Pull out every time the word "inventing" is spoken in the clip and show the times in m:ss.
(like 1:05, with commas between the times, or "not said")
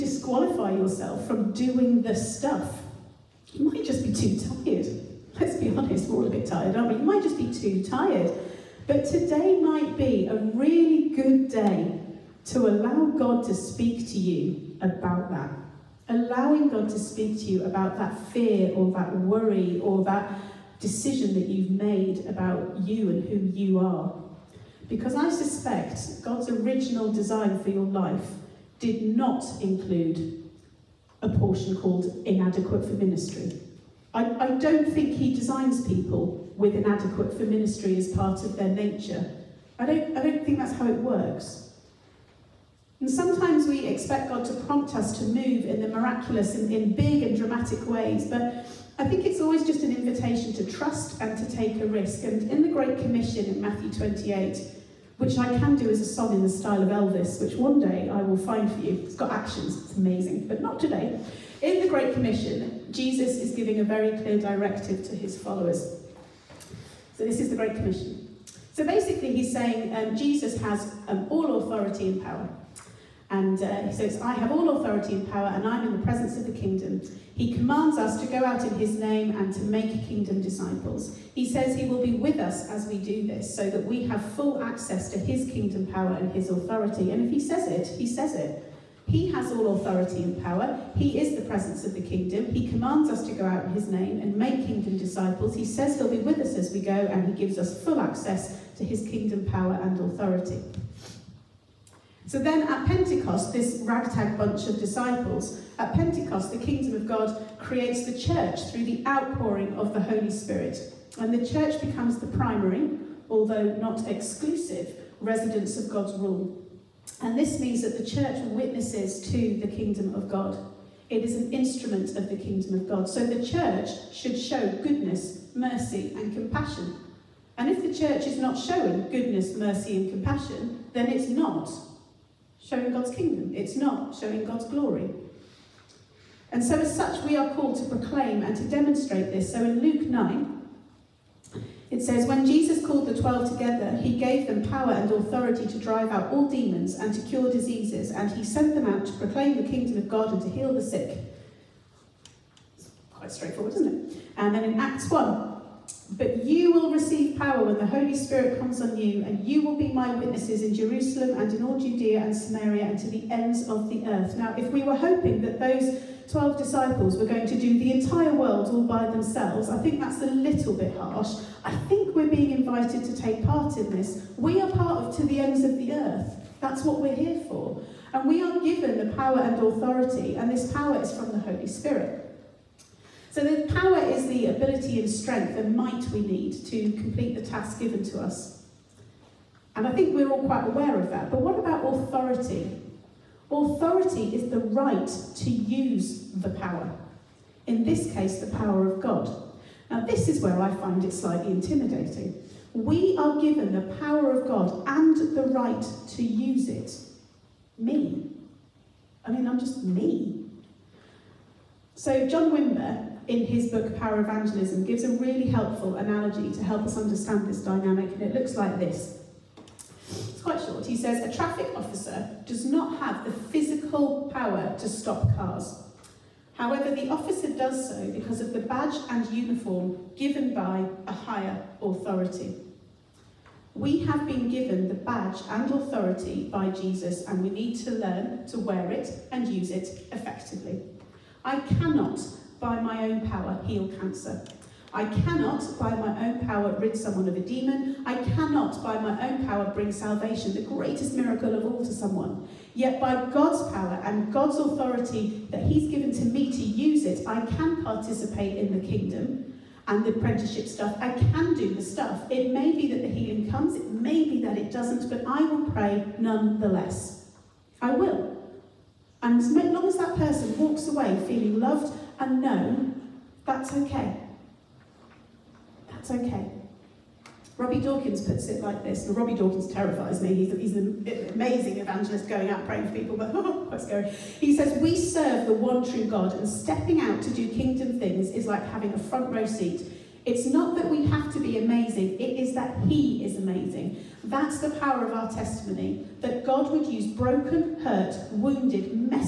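not said.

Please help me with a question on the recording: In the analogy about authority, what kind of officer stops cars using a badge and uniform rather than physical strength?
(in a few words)
Traffic officer.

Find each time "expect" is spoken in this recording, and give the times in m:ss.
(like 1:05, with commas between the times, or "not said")
0:43.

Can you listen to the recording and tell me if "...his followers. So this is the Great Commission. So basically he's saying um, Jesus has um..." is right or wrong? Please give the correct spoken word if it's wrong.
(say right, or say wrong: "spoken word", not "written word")
right.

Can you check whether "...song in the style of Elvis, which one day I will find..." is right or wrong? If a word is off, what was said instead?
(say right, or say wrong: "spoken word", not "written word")
right.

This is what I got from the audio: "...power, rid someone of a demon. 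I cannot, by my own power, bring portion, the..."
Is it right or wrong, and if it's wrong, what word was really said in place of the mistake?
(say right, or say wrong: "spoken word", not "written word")
wrong: "salvation", not "portion".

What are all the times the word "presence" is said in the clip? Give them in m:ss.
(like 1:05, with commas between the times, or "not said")
1:16, 1:31.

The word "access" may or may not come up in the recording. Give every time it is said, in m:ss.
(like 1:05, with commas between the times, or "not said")
1:24, 1:37.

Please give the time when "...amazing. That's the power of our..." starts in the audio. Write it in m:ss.
4:53.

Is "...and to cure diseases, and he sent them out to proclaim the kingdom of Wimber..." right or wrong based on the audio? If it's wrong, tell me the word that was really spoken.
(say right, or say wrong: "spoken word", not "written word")
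wrong: "God", not "Wimber".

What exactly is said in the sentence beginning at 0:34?
I, I don't think He designs people with inadequate for ministry as part of their nature.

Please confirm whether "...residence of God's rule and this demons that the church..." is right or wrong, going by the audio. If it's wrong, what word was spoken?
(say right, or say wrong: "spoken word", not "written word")
wrong: "means", not "demons".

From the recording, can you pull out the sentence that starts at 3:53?
We have been given the badge and authority by Jesus, and we need to learn to wear it and use it effectively.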